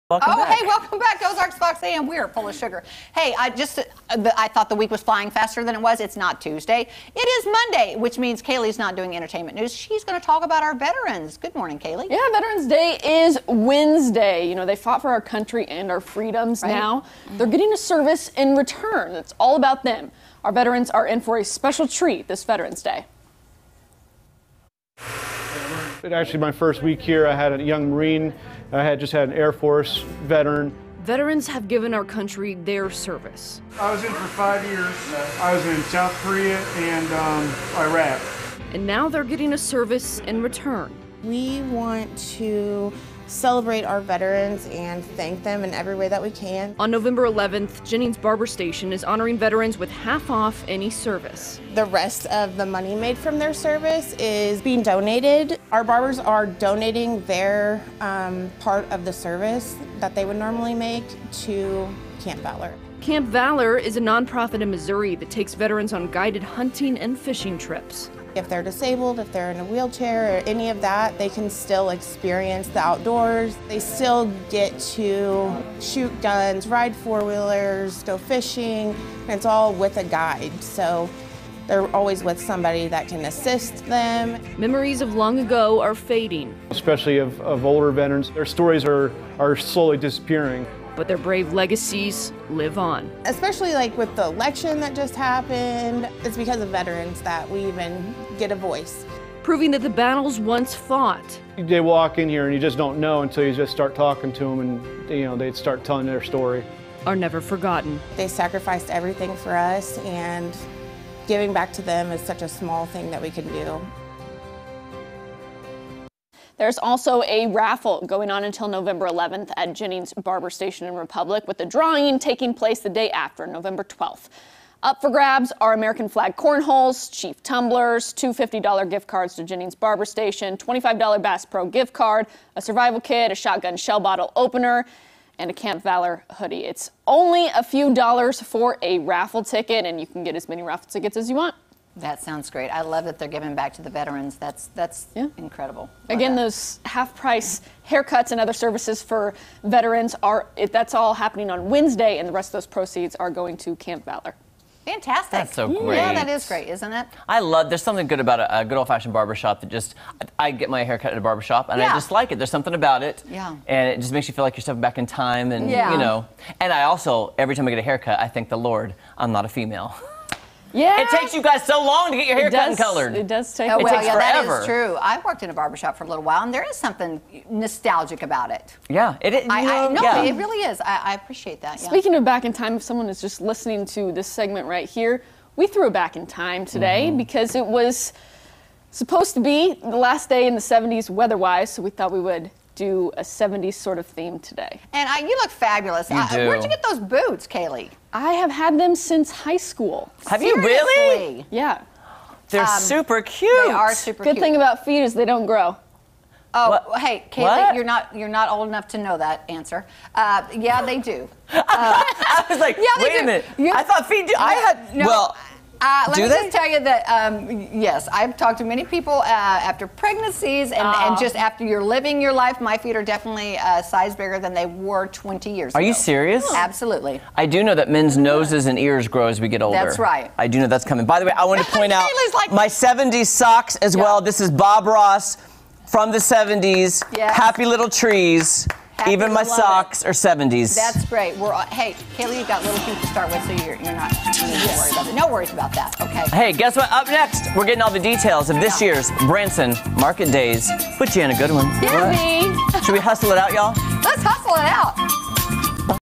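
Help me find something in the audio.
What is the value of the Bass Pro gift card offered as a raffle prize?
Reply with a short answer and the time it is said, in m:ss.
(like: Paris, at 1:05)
$25, at 2:10.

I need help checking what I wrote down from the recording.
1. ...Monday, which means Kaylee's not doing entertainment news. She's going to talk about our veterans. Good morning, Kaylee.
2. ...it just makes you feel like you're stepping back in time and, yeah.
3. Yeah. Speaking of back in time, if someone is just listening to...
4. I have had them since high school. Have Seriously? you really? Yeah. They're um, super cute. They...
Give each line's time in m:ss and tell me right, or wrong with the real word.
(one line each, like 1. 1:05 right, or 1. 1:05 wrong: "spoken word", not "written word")
1. 0:07 right
2. 2:43 right
3. 3:01 right
4. 3:18 right.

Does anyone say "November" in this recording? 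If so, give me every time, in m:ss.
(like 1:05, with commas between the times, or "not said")
0:46, 1:58, 2:03.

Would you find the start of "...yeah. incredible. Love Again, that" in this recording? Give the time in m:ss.
2:25.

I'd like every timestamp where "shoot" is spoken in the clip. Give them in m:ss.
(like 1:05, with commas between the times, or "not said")
1:15.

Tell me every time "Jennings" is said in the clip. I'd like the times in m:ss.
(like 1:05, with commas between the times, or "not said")
0:47, 1:59, 2:09.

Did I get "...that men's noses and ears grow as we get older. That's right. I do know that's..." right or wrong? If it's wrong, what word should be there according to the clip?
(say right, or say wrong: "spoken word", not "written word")
right.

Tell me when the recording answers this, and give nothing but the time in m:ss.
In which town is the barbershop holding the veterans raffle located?
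2:00.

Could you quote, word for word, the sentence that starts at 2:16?
It's only a few dollars for a raffle ticket, and you can get as many raffle tickets as you want.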